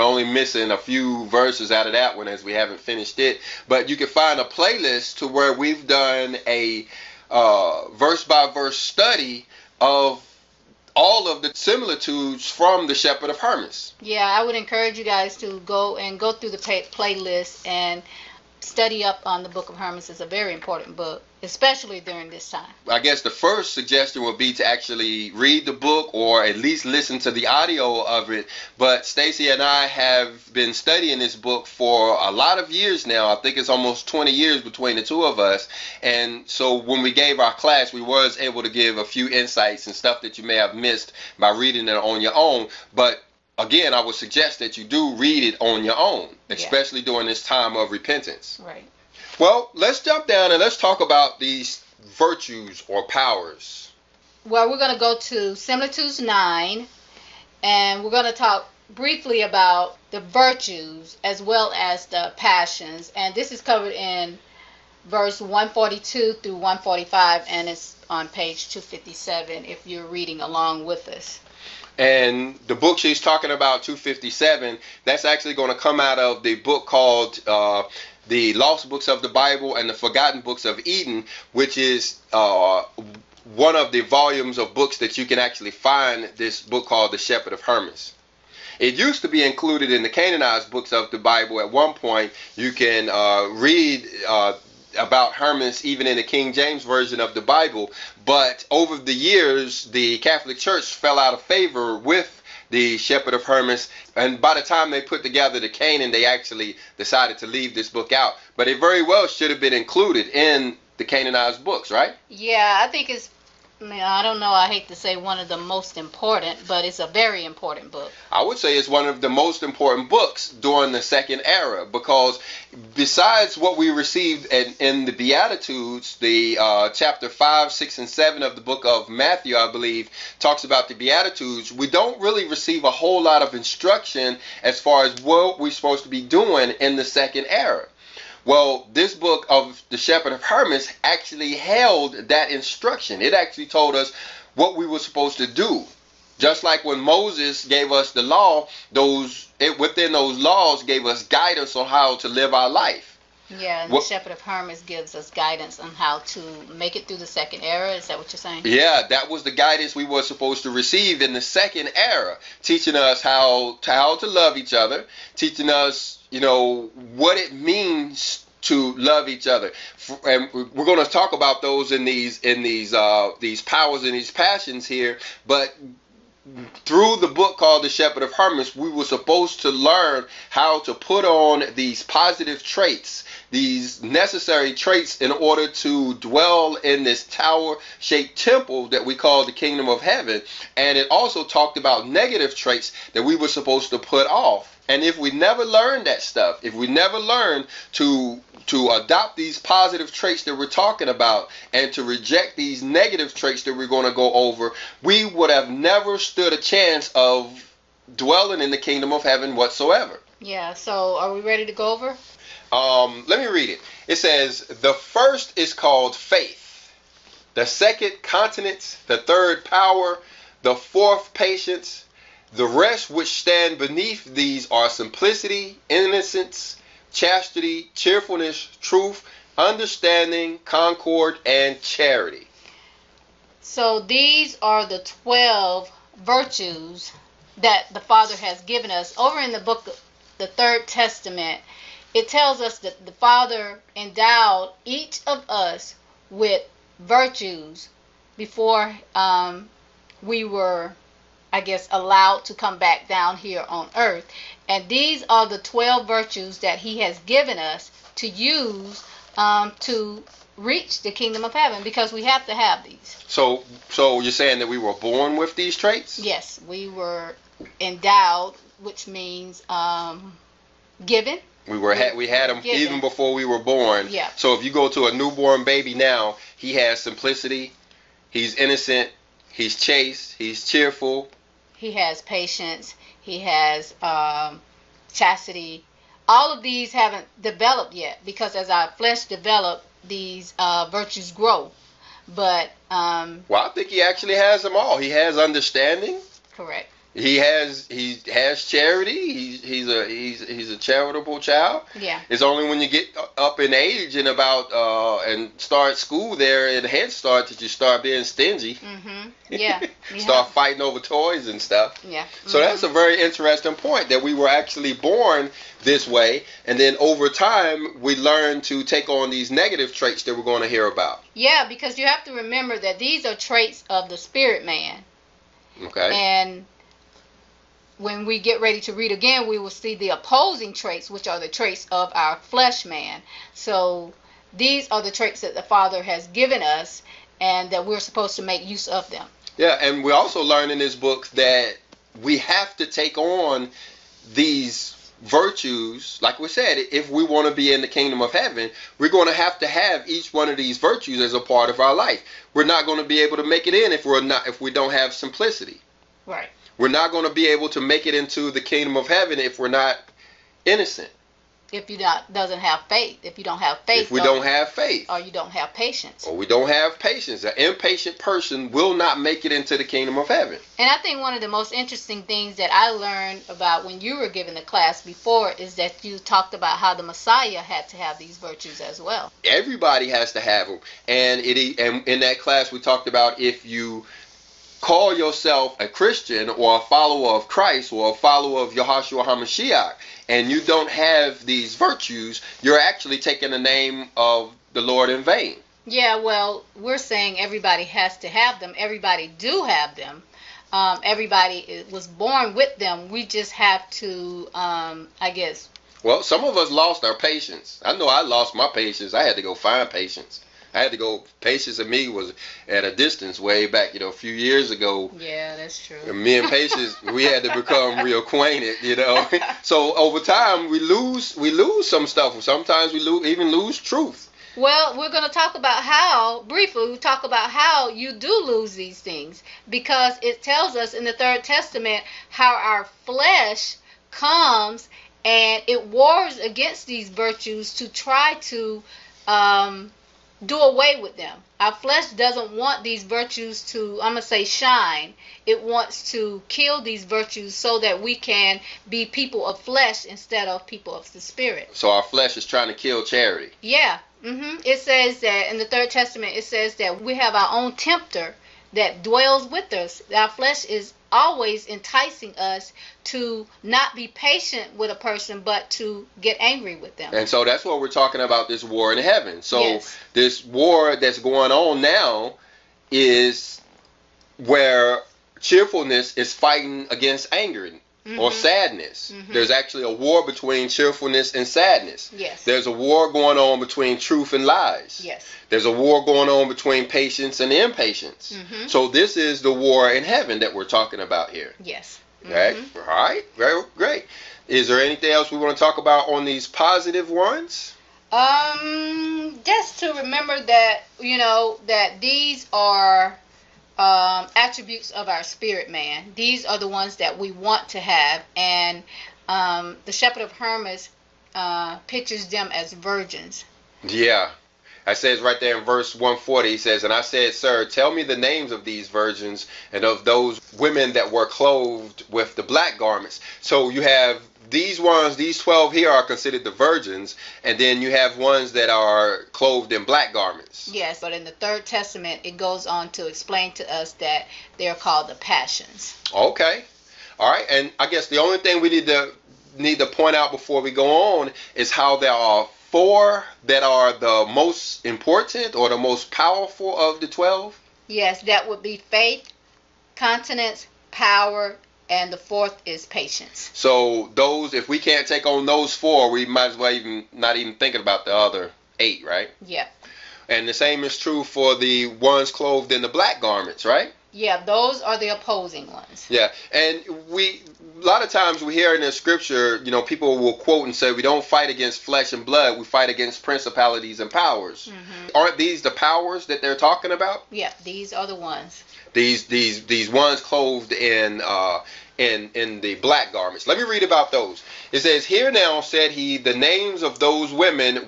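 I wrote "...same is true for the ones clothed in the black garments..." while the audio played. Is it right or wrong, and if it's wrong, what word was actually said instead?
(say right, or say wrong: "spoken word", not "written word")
right.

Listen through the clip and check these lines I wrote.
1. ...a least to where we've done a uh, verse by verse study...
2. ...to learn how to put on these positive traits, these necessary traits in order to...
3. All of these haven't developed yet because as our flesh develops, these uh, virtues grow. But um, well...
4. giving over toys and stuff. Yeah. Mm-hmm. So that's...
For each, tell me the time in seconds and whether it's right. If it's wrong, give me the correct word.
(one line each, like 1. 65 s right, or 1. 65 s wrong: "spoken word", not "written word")
1. 4 s wrong: "playlist", not "least"
2. 179 s right
3. 286 s right
4. 310 s wrong: "fighting", not "giving".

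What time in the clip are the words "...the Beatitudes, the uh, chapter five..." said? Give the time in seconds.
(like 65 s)
125 s.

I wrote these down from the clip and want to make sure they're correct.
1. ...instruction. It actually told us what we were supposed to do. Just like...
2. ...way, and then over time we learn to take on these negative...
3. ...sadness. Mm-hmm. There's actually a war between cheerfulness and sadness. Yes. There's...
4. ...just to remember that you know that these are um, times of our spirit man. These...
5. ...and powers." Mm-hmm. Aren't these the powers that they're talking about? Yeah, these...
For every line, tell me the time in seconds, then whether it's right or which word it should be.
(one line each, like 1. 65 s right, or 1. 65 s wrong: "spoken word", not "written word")
1. 142 s right
2. 316 s right
3. 478 s right
4. 499 s wrong: "attributes", not "times"
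5. 574 s right.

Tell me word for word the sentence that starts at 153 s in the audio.
Yeah, and what, the Shepherd of Hermas gives us guidance on how to make it through the second era.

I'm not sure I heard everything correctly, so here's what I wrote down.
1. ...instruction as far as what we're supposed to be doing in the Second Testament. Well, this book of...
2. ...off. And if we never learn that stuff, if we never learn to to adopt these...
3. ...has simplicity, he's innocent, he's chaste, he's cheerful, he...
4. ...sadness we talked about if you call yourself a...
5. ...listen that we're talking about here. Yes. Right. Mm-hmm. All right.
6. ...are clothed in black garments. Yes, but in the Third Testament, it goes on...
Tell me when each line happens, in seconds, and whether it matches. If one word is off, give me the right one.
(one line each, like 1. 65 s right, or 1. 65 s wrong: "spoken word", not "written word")
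1. 133 s wrong: "Era", not "Testament"
2. 194 s right
3. 276 s right
4. 382 s wrong: "class", not "sadness"
5. 490 s wrong: "heaven", not "listen"
6. 528 s right.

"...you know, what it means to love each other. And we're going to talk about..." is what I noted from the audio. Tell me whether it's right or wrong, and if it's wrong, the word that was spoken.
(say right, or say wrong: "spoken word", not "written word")
right.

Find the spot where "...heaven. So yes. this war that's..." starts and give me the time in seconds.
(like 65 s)
468 s.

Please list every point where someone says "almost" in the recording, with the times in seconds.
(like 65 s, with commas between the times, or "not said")
33 s.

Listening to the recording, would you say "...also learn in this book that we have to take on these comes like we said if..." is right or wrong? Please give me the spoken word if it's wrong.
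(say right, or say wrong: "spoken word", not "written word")
wrong: "virtues", not "comes".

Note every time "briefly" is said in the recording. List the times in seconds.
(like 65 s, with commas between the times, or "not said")
58 s, 426 s.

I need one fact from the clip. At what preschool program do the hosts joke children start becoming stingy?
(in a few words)
Head Start.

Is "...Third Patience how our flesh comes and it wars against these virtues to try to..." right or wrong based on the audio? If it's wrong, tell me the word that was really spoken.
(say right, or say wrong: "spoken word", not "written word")
wrong: "Testament", not "Patience".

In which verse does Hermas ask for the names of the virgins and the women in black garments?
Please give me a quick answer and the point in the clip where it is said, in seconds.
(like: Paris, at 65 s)
Verse 140, at 515 s.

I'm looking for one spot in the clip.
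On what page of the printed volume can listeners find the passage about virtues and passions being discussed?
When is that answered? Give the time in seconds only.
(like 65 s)
68 s.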